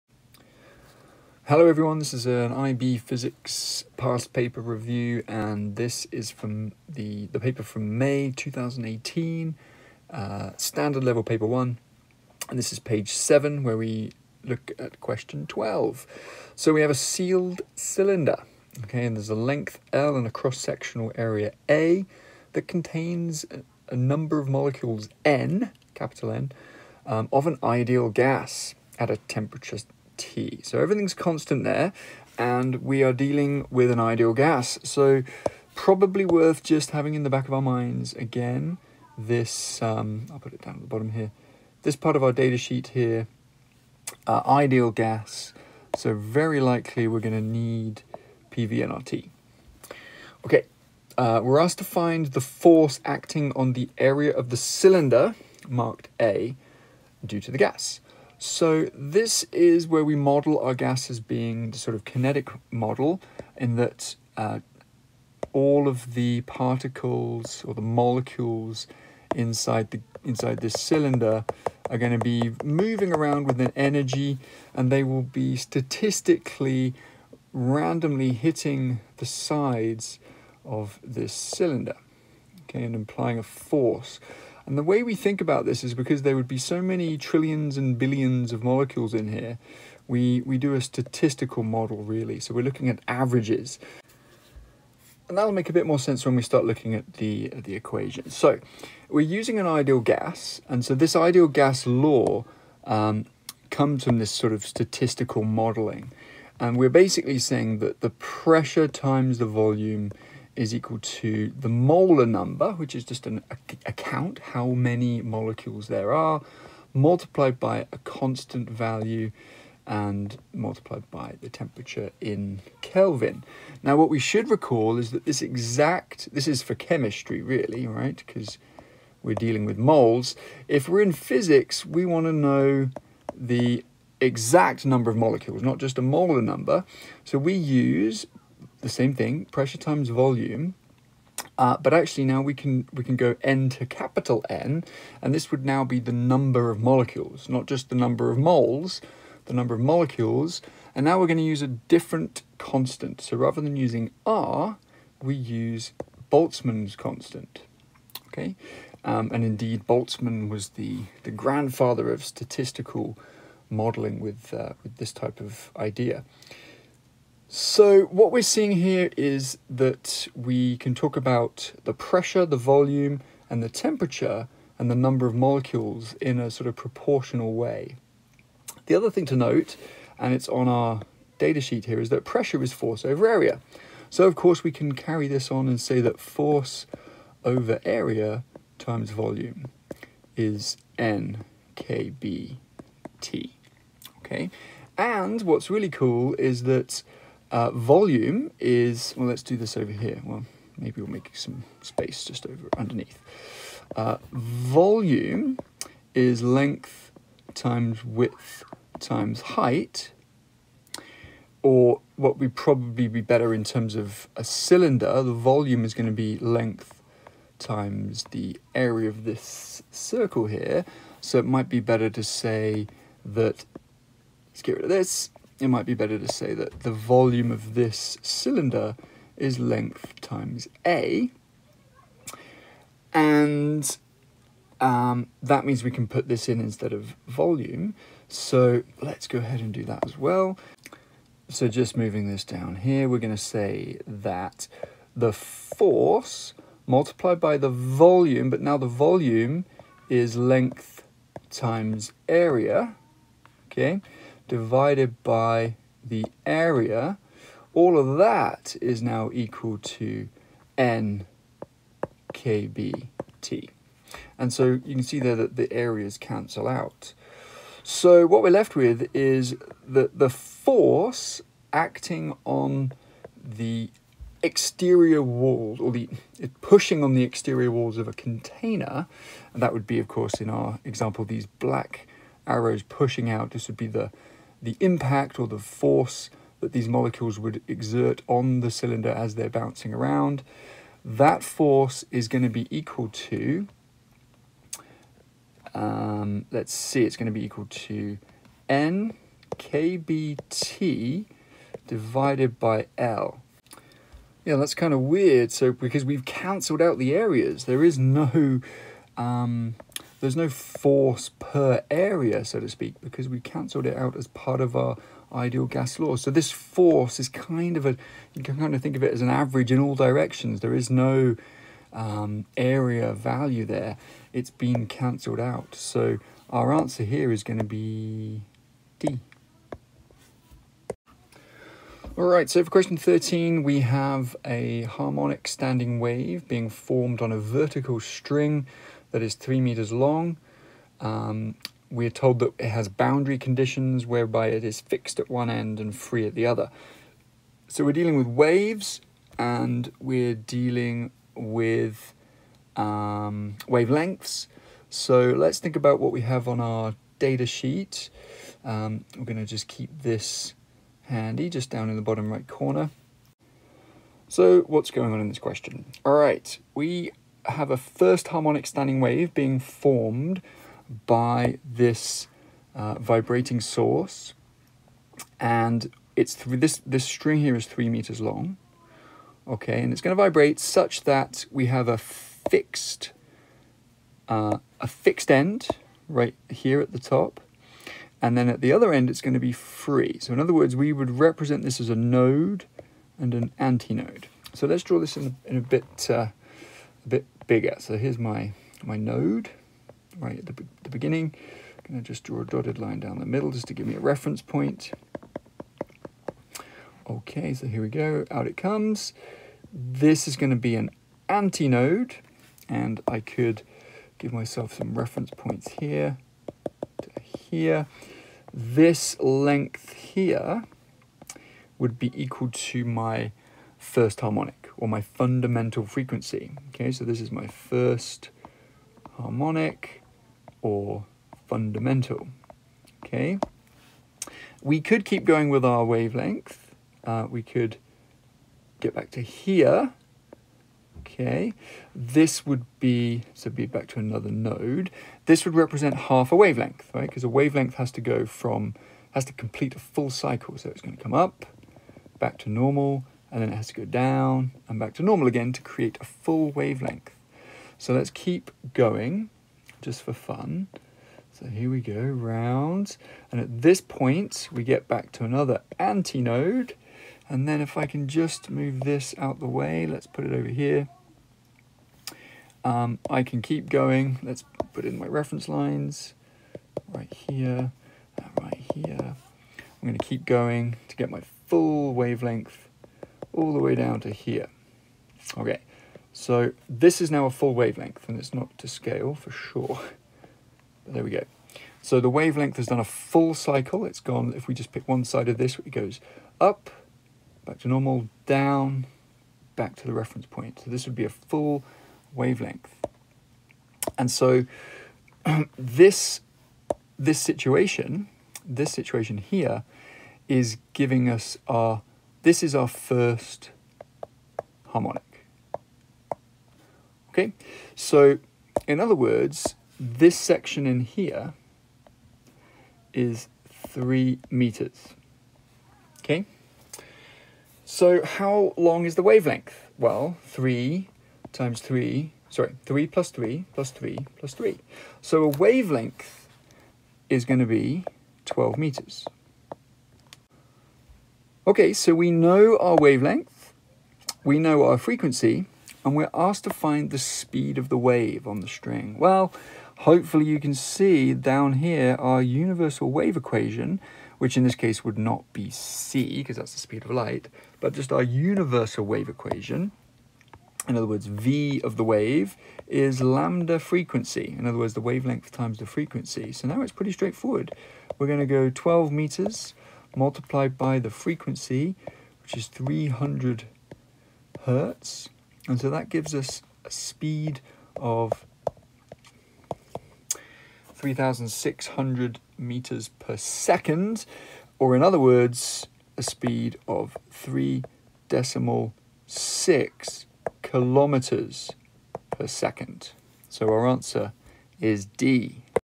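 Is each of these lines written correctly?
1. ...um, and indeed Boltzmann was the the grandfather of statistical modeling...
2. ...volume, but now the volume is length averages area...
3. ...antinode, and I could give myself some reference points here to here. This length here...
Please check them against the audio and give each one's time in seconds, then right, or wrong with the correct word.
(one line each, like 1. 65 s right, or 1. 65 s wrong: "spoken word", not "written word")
1. 159 s right
2. 247 s wrong: "times", not "averages"
3. 411 s right.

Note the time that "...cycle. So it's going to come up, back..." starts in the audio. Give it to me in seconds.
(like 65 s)
450 s.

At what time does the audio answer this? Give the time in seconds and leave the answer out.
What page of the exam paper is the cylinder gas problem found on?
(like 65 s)
12 s.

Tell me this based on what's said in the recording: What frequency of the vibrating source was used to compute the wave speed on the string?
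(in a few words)
300 hertz.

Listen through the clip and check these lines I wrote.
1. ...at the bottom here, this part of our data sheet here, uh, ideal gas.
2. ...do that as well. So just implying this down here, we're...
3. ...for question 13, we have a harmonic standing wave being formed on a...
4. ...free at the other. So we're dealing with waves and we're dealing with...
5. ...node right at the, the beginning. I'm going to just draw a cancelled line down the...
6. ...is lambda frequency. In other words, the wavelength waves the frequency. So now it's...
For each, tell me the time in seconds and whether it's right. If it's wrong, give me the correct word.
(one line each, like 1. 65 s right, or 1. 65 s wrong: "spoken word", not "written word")
1. 40 s right
2. 239 s wrong: "moving", not "implying"
3. 332 s right
4. 345 s right
5. 398 s wrong: "dotted", not "cancelled"
6. 562 s wrong: "times", not "waves".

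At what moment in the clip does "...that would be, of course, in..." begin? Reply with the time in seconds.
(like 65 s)
279 s.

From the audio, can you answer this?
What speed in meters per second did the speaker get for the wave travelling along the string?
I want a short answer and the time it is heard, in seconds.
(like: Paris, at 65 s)
3600 m/s, at 580 s.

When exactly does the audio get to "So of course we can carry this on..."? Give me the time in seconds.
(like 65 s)
184 s.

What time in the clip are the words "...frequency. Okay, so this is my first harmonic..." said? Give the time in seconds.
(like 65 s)
425 s.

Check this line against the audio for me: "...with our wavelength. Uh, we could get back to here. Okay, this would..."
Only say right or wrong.
right.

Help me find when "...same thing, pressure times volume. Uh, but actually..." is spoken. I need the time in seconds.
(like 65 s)
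138 s.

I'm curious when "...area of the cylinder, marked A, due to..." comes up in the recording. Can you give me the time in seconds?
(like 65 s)
53 s.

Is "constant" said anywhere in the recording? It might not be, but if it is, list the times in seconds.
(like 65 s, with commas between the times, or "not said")
31 s, 117 s, 152 s, 156 s.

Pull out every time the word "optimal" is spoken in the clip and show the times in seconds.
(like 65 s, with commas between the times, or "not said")
not said.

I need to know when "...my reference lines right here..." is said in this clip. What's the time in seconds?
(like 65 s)
474 s.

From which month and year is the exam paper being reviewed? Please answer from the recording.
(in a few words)
May 2018.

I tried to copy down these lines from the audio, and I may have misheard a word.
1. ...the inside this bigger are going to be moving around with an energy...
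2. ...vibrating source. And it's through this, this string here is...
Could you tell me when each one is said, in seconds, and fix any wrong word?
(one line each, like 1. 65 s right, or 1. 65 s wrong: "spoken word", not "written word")
1. 69 s wrong: "cylinder", not "bigger"
2. 372 s right.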